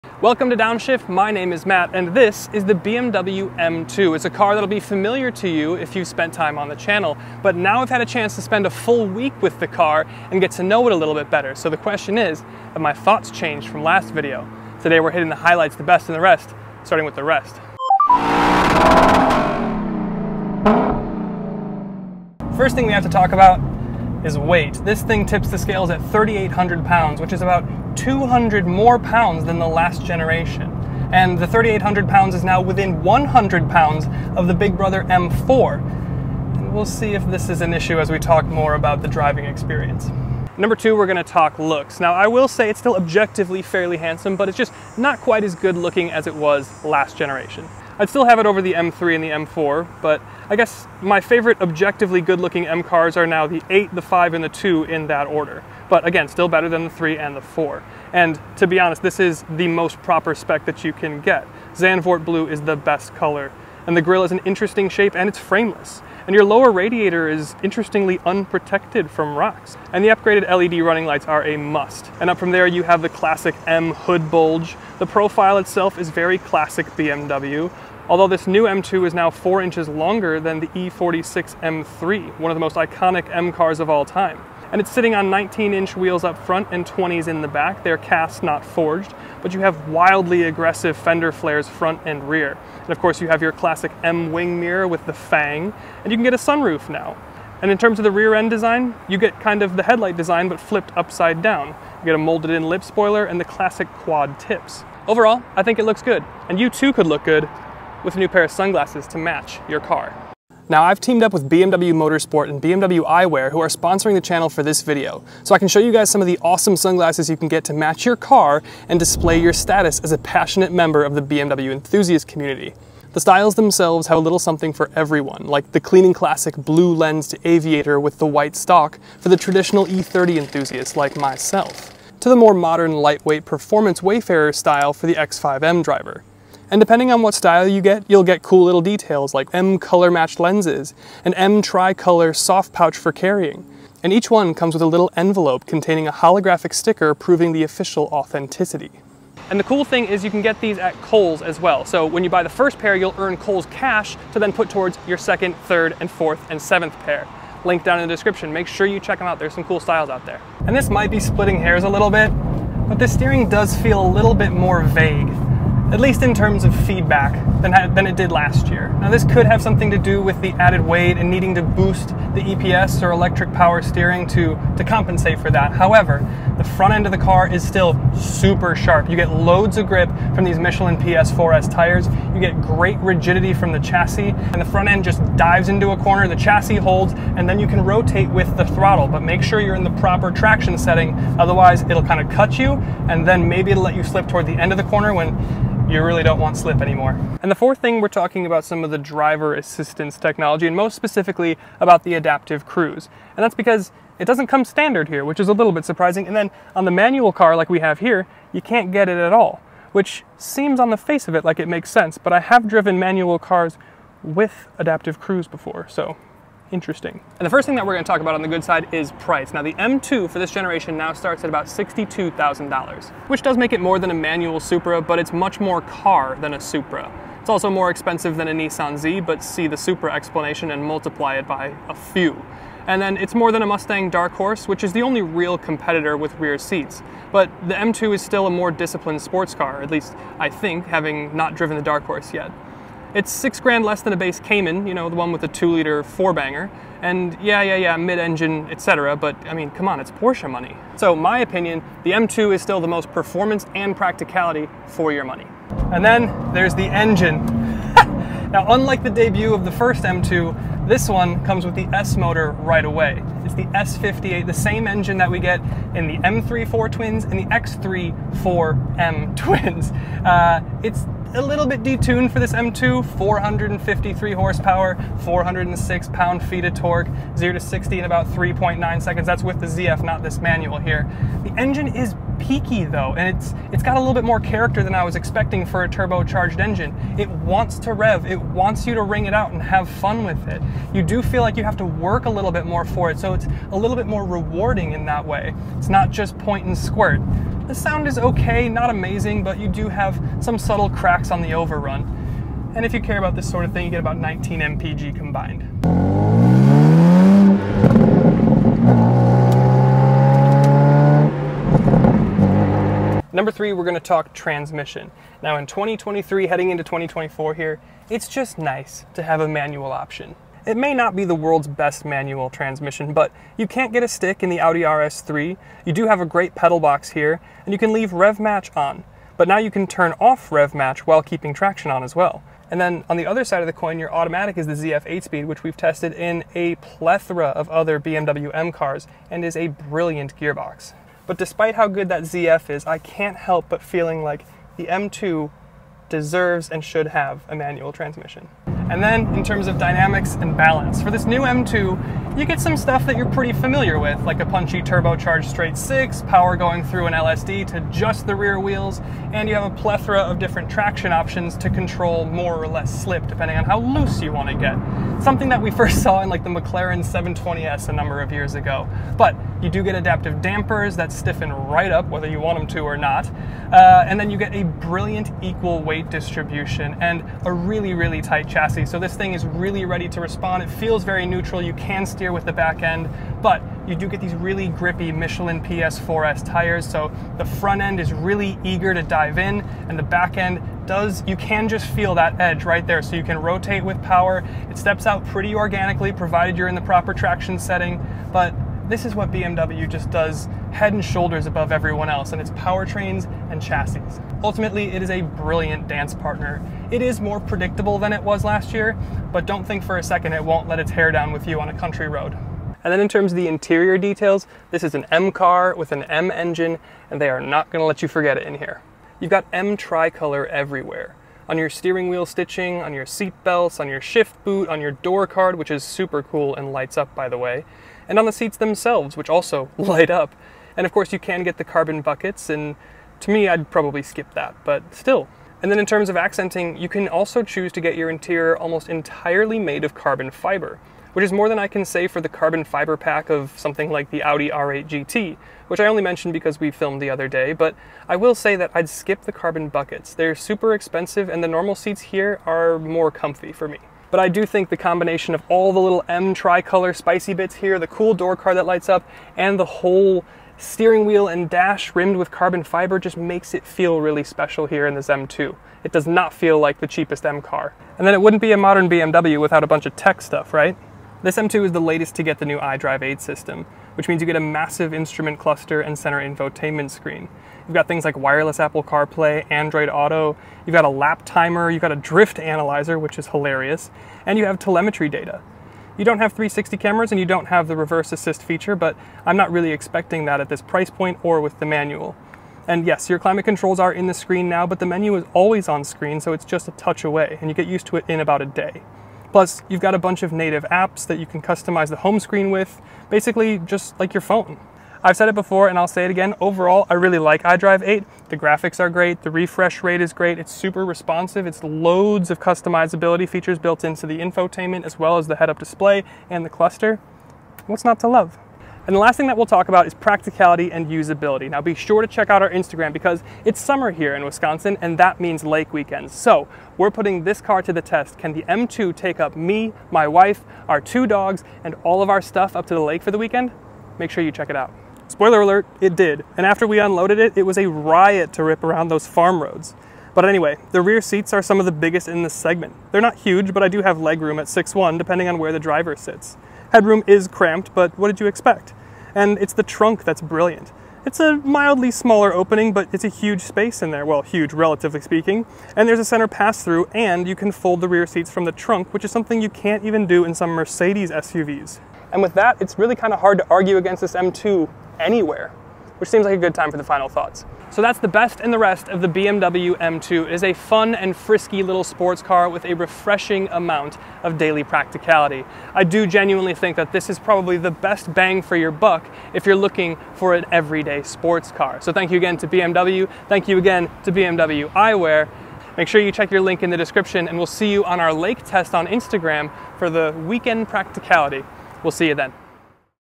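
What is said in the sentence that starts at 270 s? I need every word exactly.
Uh, it's a little bit detuned for this M2, 453 horsepower, 406 pound-feet of torque, 0 to 60 in about 3.9 seconds.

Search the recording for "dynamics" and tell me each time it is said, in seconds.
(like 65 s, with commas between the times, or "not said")
349 s.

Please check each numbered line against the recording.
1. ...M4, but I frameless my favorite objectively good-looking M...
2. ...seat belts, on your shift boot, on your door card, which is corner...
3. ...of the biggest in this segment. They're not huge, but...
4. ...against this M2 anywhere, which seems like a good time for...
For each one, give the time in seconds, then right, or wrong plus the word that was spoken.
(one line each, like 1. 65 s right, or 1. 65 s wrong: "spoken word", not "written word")
1. 49 s wrong: "guess", not "frameless"
2. 423 s wrong: "super", not "corner"
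3. 541 s right
4. 563 s right.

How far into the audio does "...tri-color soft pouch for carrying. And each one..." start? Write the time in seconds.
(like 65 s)
141 s.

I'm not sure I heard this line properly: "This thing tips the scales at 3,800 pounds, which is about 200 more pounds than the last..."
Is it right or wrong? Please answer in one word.
right.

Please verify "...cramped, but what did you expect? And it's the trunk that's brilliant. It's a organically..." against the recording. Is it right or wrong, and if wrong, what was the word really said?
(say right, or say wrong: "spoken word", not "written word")
wrong: "mildly", not "organically".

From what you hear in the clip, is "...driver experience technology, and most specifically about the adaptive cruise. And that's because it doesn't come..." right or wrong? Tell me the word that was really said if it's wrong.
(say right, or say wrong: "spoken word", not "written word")
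wrong: "assistance", not "experience".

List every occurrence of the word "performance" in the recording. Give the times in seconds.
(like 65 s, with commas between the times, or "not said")
133 s, 253 s.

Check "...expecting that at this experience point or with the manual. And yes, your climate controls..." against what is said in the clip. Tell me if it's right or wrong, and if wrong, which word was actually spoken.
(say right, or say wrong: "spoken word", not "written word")
wrong: "price", not "experience".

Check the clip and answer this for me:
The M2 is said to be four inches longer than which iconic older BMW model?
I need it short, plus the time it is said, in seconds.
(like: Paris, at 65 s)
E46 M3, at 80 s.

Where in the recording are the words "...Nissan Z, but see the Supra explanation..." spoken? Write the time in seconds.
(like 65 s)
228 s.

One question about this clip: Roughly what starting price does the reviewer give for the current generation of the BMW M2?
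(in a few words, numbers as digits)
$62,000.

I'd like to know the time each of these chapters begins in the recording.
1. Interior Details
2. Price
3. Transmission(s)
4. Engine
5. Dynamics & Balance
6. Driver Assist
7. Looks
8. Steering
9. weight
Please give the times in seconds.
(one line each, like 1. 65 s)
1. 414 s
2. 218 s
3. 314 s
4. 257 s
5. 350 s
6. 198 s
7. 44 s
8. 162 s
9. 22 s.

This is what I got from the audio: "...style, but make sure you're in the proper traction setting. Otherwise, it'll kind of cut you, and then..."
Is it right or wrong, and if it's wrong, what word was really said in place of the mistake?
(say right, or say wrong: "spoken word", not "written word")
wrong: "throttle", not "style".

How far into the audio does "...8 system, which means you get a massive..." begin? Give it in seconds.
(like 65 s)
473 s.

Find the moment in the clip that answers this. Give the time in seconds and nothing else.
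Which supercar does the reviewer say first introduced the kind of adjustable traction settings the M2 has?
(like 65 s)
366 s.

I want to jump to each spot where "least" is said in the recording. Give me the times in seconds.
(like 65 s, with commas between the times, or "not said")
165 s, 239 s.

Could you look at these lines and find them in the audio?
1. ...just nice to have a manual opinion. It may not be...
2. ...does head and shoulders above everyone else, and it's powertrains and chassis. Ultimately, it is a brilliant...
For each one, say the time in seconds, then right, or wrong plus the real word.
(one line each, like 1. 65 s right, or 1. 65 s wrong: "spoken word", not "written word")
1. 318 s wrong: "option", not "opinion"
2. 400 s right.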